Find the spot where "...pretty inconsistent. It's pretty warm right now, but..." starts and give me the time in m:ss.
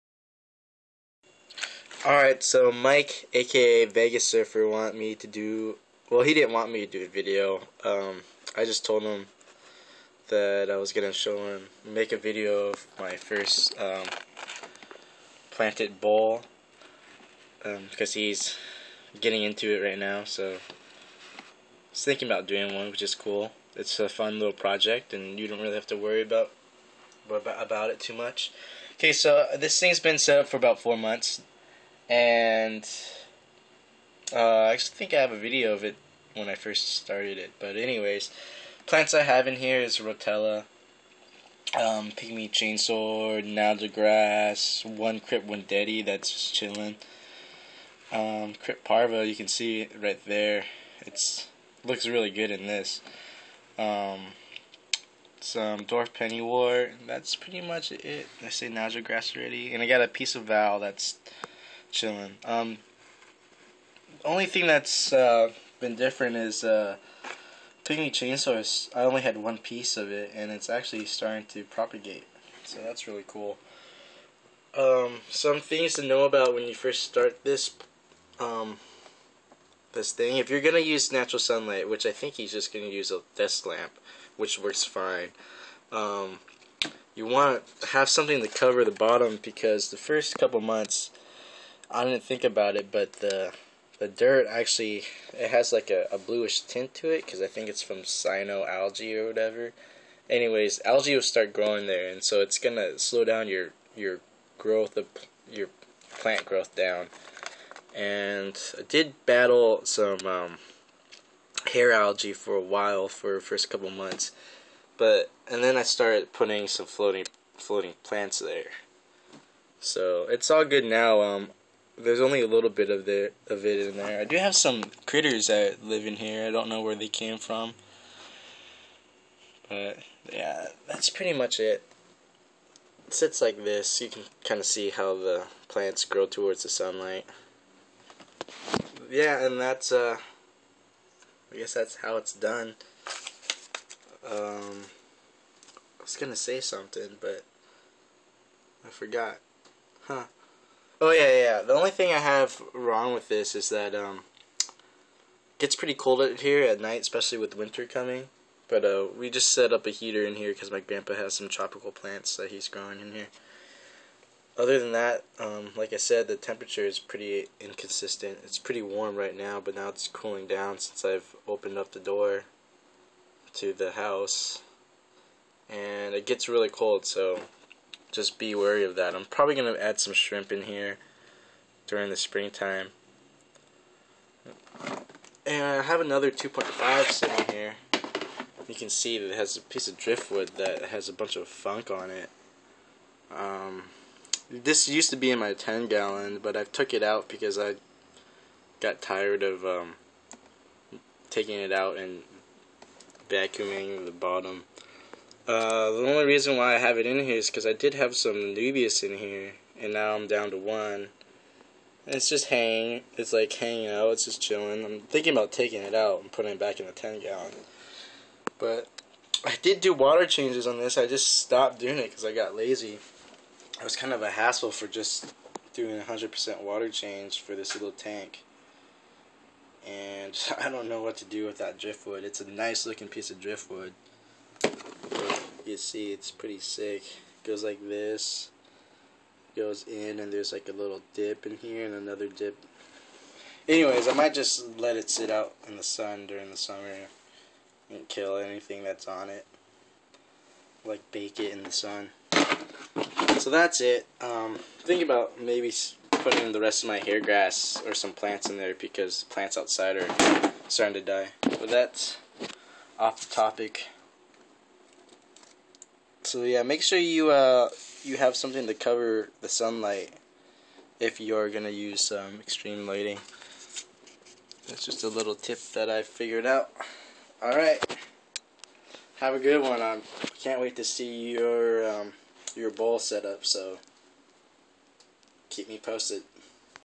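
2:46.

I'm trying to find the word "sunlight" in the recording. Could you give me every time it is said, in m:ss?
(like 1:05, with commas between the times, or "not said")
1:21, 2:16, 4:29.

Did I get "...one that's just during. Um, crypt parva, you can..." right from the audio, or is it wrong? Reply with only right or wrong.
wrong.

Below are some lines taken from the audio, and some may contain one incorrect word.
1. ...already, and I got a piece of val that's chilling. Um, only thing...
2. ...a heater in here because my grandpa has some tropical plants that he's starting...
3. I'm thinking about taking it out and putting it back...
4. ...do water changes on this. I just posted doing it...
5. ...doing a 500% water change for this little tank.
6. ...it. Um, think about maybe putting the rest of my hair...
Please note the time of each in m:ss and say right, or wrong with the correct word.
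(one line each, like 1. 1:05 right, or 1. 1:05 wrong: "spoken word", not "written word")
1. 0:59 right
2. 2:39 wrong: "growing", not "starting"
3. 3:34 right
4. 3:39 wrong: "stopped", not "posted"
5. 3:45 wrong: "100", not "500"
6. 4:13 right.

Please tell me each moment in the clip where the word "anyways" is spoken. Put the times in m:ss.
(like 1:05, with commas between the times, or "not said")
0:37, 1:40, 4:03.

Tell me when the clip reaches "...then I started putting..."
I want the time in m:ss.
1:55.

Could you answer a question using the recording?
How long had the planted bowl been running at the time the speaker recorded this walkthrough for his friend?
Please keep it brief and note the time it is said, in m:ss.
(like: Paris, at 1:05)
4 months, at 0:30.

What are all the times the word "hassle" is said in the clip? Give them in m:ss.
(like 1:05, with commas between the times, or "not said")
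3:44.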